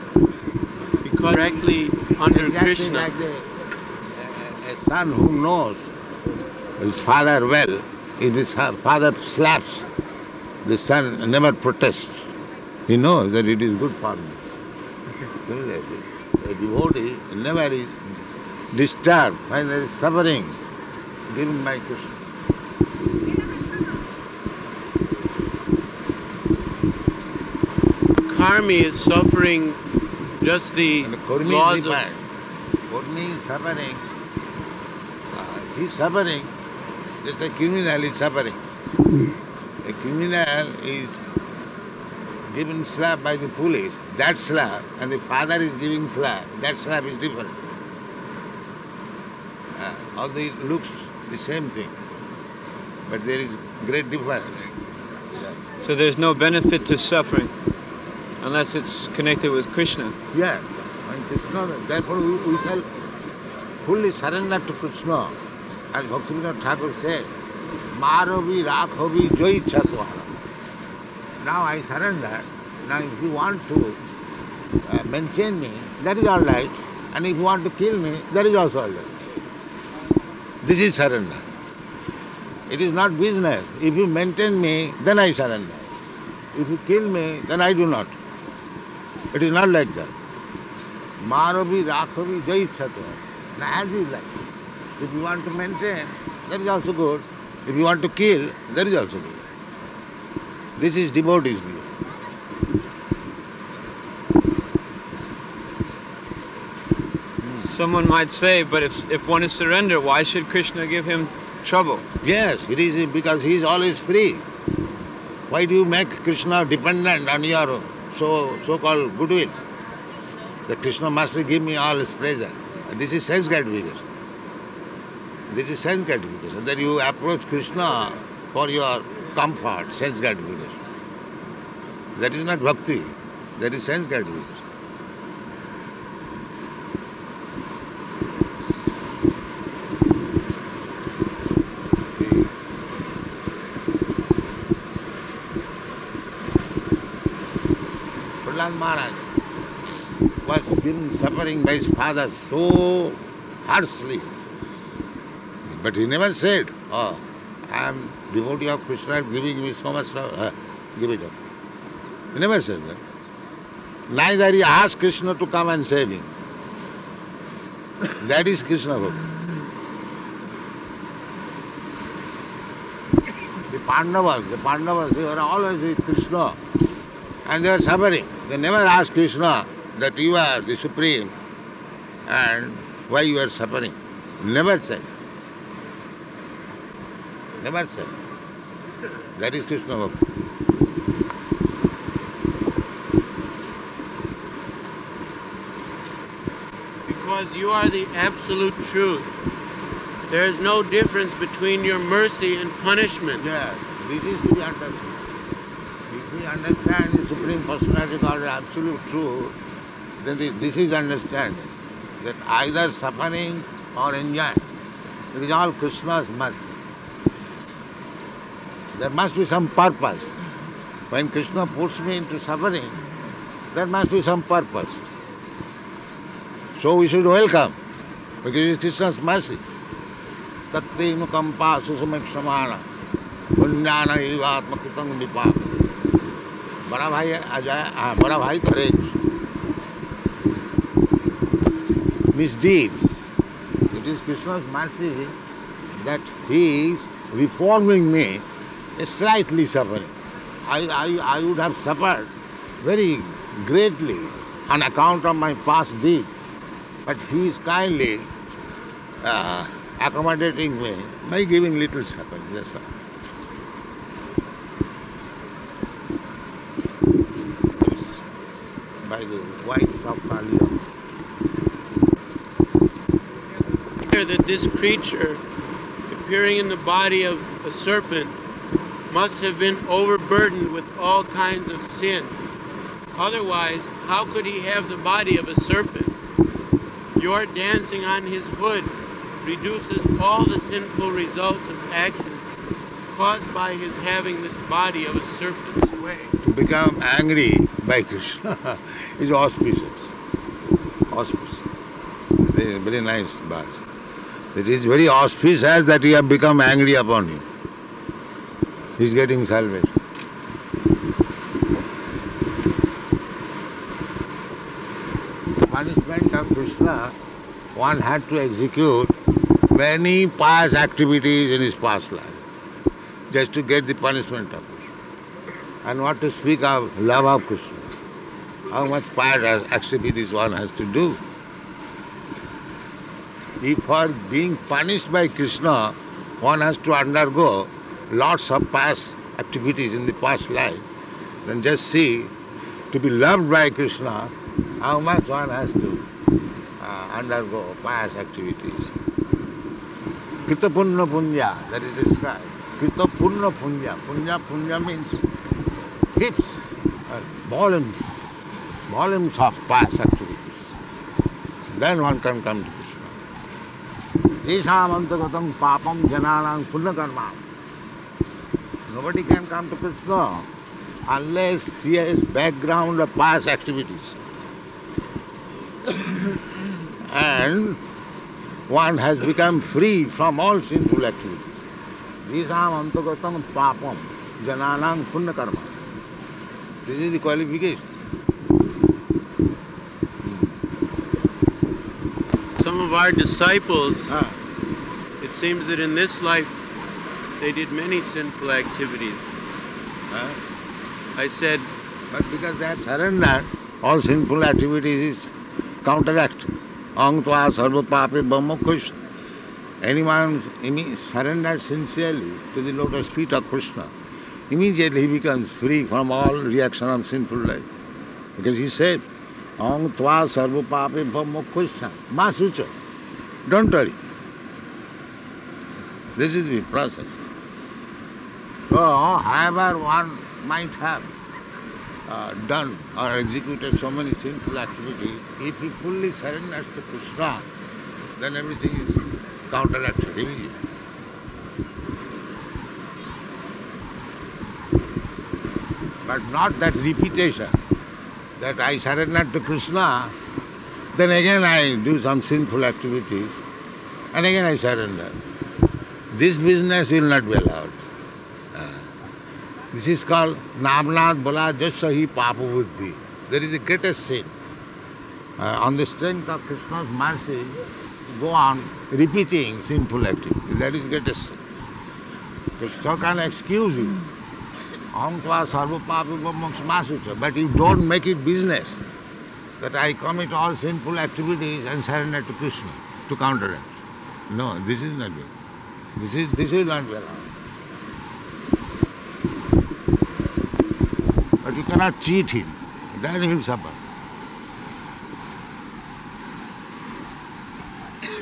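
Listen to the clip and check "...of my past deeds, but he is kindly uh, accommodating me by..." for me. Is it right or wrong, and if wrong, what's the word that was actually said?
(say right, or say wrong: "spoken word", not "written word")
right.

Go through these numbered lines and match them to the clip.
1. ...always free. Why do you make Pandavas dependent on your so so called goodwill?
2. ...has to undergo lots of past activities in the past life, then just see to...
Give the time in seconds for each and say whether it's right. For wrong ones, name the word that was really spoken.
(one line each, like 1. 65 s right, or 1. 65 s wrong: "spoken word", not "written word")
1. 113 s wrong: "Krishna", not "Pandavas"
2. 336 s right.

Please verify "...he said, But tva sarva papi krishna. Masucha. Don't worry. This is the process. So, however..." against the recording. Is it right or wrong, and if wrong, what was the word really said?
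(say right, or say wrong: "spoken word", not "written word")
wrong: "Ang", not "But".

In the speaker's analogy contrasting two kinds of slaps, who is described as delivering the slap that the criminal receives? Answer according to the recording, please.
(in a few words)
the police.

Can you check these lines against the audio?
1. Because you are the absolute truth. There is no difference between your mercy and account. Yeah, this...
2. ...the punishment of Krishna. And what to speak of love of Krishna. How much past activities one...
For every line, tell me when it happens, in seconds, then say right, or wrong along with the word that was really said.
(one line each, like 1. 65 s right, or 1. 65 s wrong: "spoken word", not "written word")
1. 197 s wrong: "punishment", not "account"
2. 323 s right.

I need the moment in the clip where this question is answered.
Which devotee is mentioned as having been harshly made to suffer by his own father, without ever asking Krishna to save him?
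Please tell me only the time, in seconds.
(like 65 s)
148 s.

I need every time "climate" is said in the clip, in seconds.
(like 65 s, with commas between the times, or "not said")
not said.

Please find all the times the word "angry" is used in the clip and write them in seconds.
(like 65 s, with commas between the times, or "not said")
297 s, 306 s.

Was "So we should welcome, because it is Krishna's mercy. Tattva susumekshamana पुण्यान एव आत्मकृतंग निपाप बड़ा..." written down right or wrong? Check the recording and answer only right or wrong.
right.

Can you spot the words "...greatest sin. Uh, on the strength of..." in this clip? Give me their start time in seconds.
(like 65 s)
463 s.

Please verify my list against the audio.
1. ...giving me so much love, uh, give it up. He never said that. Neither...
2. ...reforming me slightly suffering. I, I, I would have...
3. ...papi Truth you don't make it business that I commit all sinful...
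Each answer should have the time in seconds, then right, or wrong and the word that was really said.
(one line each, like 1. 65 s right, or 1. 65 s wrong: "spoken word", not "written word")
1. 159 s right
2. 247 s right
3. 475 s wrong: "But", not "Truth".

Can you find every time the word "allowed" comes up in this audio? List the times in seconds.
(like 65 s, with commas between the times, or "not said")
457 s, 487 s.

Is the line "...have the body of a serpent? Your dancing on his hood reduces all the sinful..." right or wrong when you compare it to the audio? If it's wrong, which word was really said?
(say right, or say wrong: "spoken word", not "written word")
right.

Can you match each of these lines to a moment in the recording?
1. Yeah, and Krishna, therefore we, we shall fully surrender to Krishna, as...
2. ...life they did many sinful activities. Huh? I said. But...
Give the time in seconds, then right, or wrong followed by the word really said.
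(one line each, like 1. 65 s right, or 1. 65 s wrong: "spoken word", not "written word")
1. 60 s right
2. 396 s right.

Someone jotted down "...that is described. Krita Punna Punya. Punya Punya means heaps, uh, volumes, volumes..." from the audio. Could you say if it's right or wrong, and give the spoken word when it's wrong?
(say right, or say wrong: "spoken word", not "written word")
right.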